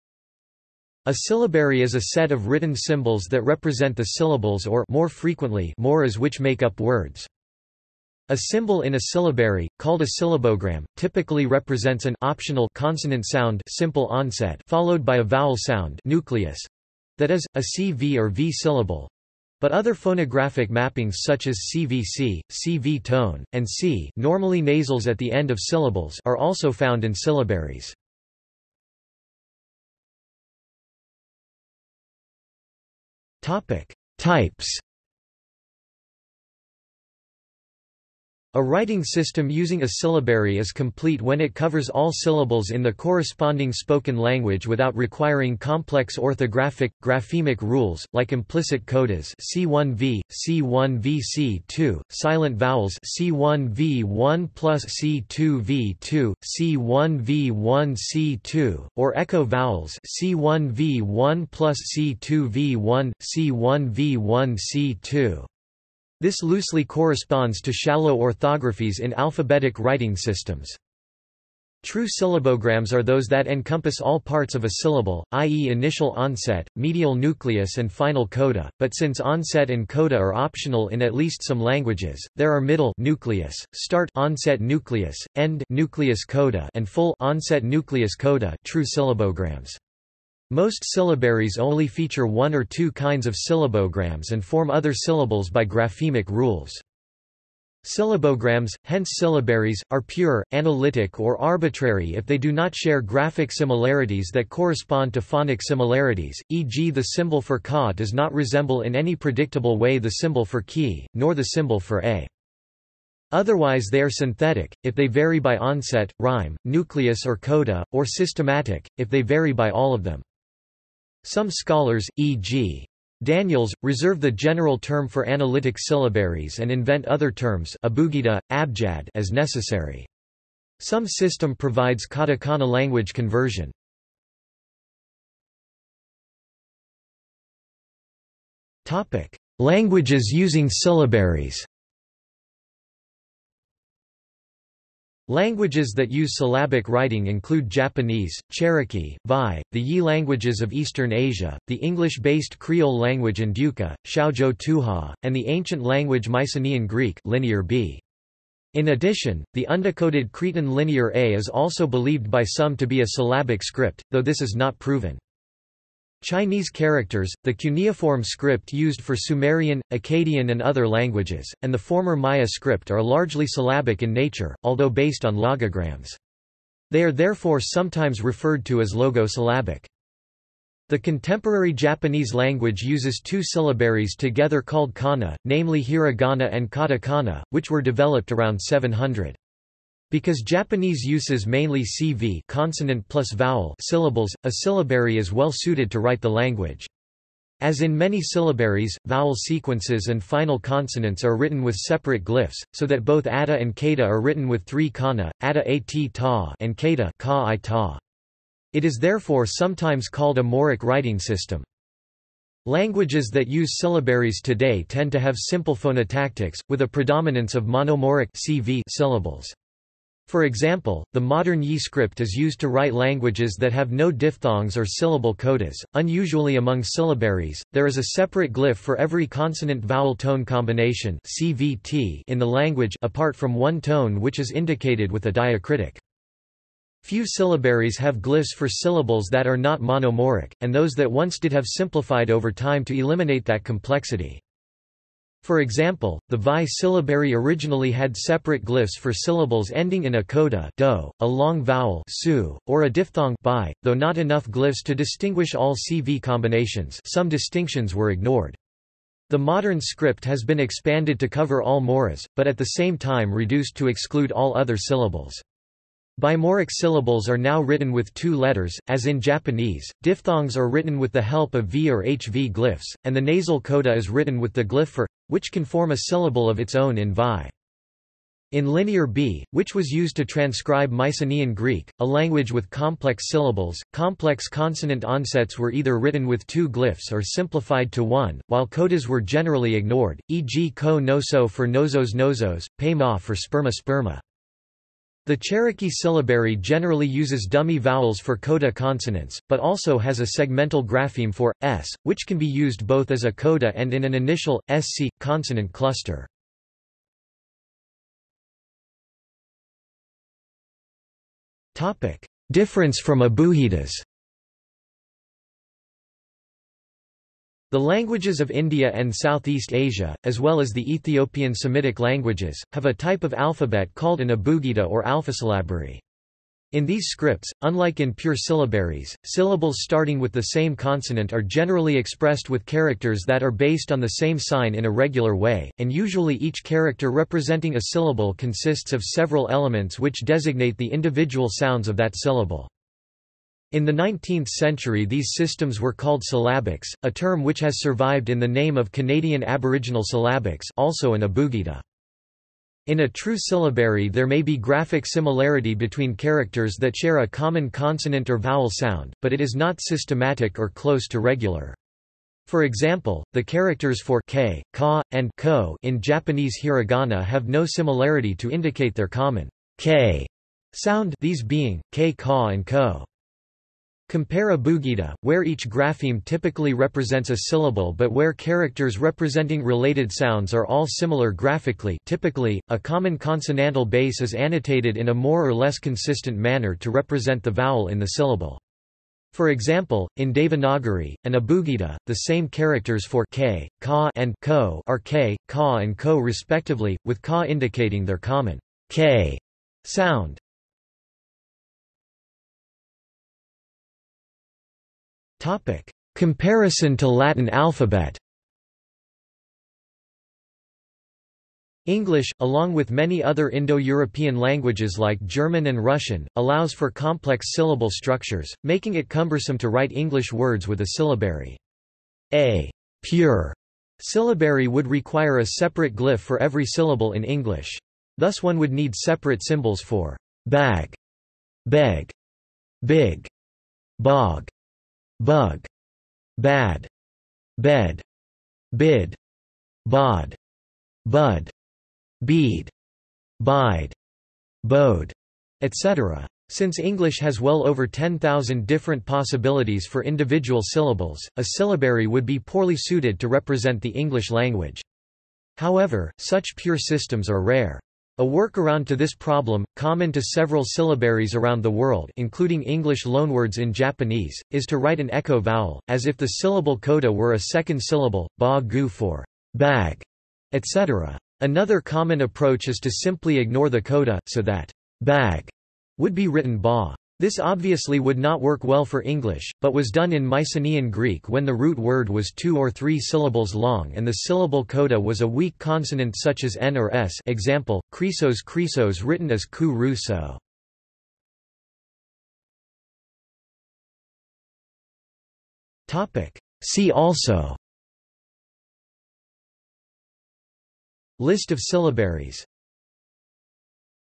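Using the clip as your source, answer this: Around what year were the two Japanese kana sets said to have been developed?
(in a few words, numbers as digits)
700.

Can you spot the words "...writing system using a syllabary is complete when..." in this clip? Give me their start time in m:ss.
0:38.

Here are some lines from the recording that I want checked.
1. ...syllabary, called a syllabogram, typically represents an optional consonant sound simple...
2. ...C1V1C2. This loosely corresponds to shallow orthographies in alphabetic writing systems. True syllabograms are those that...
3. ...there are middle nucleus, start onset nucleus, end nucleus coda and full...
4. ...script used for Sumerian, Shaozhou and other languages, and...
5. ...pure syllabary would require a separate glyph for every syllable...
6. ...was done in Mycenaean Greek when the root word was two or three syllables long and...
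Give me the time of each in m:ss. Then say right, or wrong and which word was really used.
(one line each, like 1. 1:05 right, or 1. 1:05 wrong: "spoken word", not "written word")
1. 0:09 right
2. 1:03 right
3. 1:22 right
4. 2:48 wrong: "Akkadian", not "Shaozhou"
5. 7:03 right
6. 7:59 right.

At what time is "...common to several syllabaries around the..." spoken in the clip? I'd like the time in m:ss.
7:39.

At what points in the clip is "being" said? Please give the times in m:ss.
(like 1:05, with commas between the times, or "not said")
6:11.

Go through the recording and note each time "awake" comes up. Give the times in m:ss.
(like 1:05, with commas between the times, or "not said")
not said.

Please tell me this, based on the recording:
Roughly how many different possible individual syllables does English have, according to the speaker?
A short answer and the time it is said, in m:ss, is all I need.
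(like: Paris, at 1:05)
over 10,000, at 7:27.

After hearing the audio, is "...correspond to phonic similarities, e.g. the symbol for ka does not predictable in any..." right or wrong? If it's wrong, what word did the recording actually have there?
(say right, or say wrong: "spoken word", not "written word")
wrong: "resemble", not "predictable".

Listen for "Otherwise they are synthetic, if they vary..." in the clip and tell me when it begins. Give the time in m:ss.
1:53.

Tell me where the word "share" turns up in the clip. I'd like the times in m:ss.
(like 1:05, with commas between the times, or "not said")
1:42, 5:56.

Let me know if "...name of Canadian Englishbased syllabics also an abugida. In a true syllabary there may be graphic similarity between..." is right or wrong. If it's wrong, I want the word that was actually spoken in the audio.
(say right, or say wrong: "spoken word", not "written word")
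wrong: "Aboriginal", not "Englishbased".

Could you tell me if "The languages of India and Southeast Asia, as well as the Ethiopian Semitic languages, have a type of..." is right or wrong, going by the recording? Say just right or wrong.
right.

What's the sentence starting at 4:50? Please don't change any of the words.
ko noso for Knossos Knossos, pema for sperma sperma.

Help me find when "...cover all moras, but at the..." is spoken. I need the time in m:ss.
4:21.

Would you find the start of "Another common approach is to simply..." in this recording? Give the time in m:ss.
7:51.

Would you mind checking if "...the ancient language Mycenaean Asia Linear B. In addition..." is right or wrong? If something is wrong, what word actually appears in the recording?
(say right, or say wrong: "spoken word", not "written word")
wrong: "Greek", not "Asia".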